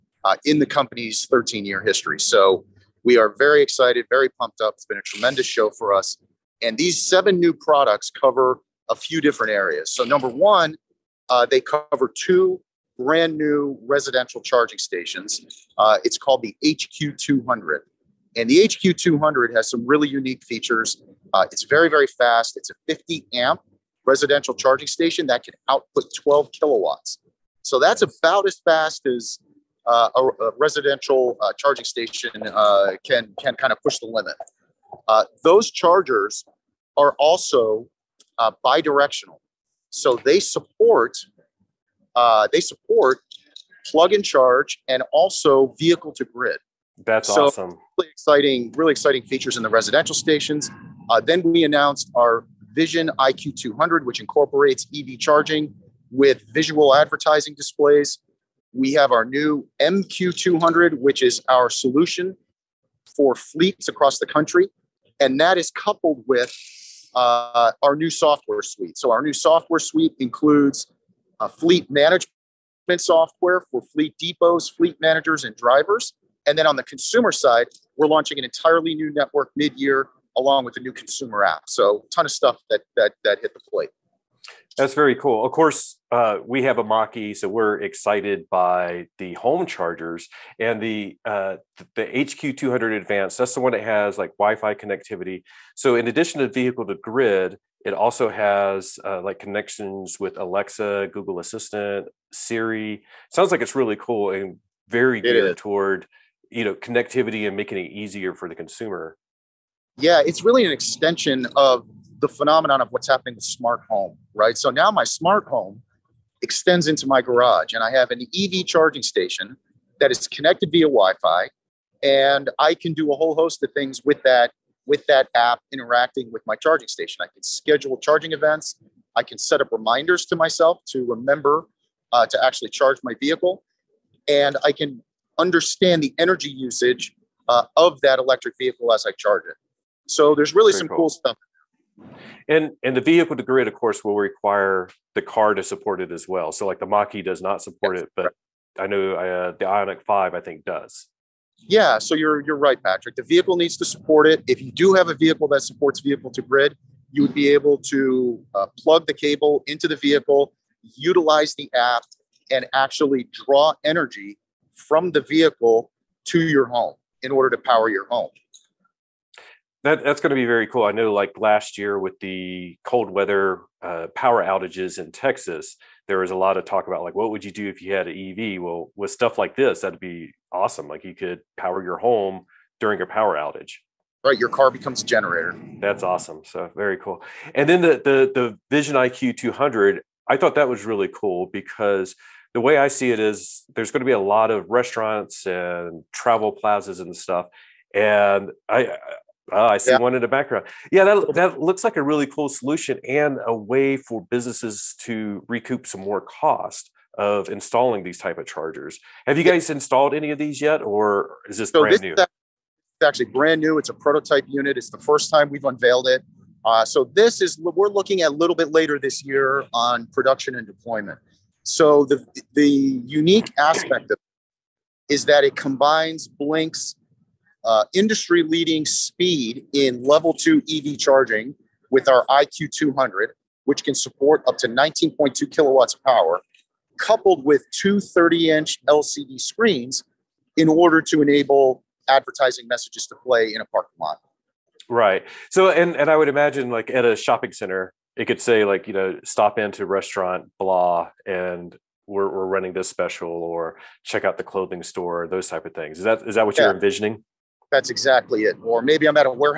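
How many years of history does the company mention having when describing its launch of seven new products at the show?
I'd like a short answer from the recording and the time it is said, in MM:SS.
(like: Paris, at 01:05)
13, at 00:01.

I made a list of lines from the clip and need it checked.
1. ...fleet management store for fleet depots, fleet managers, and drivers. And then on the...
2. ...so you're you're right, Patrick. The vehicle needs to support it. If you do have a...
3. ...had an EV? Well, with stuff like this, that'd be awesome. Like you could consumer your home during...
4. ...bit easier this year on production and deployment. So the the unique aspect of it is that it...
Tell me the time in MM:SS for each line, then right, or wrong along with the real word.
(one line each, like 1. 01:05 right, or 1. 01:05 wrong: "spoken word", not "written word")
1. 01:11 wrong: "software", not "store"
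2. 02:31 right
3. 02:57 wrong: "power", not "consumer"
4. 03:38 wrong: "later", not "easier".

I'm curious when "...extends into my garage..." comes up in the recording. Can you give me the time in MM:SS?
01:56.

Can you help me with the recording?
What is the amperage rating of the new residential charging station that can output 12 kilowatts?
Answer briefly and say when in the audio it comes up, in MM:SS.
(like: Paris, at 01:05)
50 amp, at 00:22.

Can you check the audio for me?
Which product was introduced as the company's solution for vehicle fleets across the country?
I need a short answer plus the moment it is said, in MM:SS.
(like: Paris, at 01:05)
MQ 200, at 00:59.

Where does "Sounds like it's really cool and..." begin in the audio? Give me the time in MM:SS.
01:43.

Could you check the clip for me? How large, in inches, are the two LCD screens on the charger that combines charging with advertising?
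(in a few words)
30 inch.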